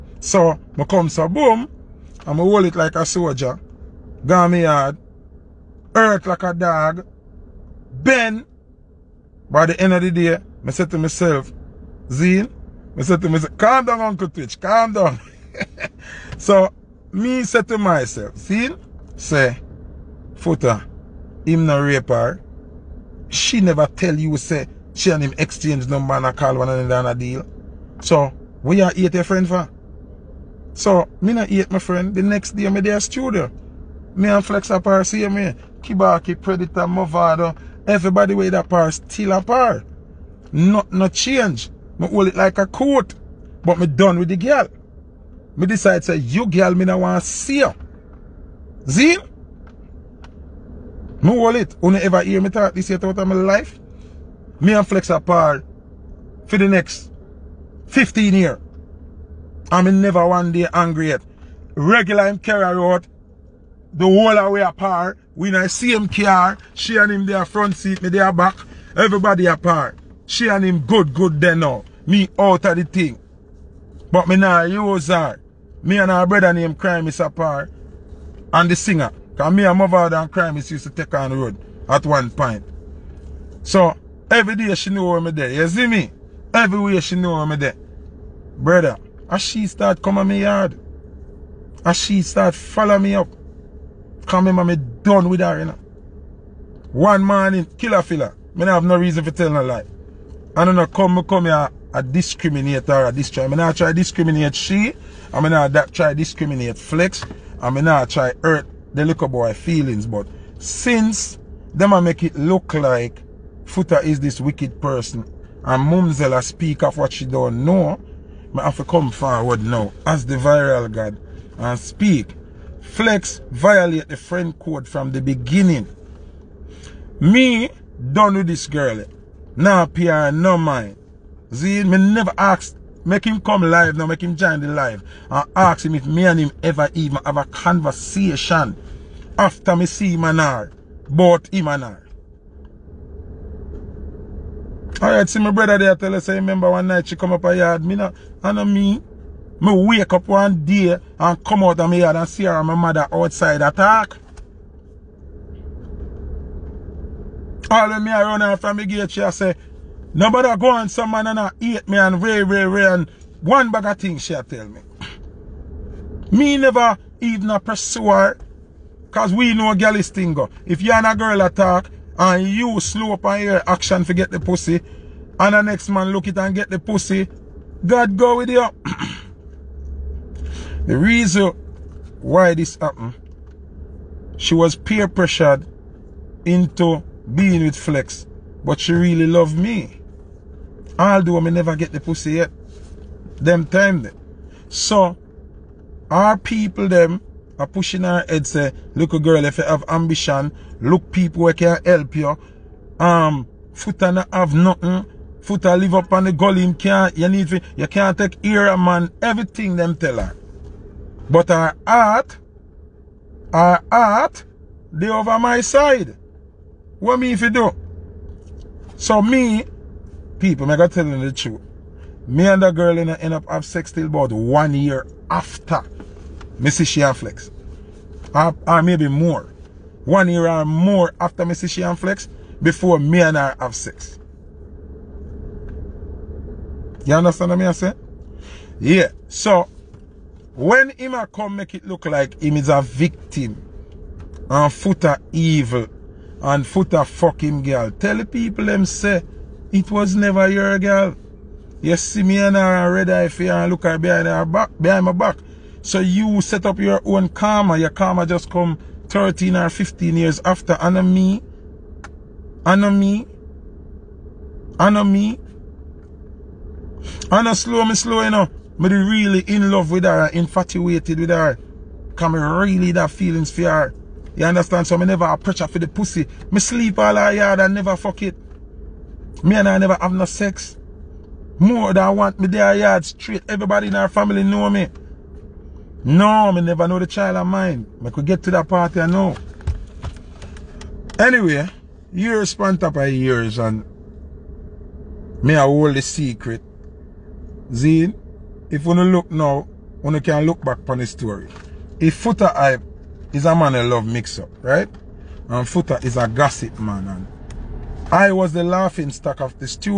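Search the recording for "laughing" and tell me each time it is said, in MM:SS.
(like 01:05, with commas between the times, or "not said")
05:08.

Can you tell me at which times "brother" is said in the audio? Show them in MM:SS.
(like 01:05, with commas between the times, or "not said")
01:16, 01:28, 02:25.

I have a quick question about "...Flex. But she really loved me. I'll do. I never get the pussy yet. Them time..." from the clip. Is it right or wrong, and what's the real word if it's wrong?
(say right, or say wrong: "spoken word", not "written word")
right.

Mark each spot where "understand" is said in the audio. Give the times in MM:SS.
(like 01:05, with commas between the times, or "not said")
03:57, 04:34.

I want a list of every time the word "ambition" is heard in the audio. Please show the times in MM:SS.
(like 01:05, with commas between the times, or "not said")
03:19.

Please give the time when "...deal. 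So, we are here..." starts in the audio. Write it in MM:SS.
00:27.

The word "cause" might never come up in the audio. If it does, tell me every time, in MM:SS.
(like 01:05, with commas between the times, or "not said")
01:19, 02:49.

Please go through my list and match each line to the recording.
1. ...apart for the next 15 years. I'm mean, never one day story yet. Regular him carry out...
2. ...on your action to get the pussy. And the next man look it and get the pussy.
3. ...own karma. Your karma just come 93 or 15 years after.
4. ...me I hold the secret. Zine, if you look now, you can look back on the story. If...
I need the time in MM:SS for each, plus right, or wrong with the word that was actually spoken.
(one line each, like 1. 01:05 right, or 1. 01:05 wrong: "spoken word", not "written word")
1. 00:55 wrong: "angry", not "story"
2. 02:53 right
3. 04:17 wrong: "13", not "93"
4. 04:55 right.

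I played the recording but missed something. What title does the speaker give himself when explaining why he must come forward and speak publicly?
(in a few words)
the viral god.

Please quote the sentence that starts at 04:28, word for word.
Me really in love with her, infatuated with her.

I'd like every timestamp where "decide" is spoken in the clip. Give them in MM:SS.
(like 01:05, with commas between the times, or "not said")
00:45.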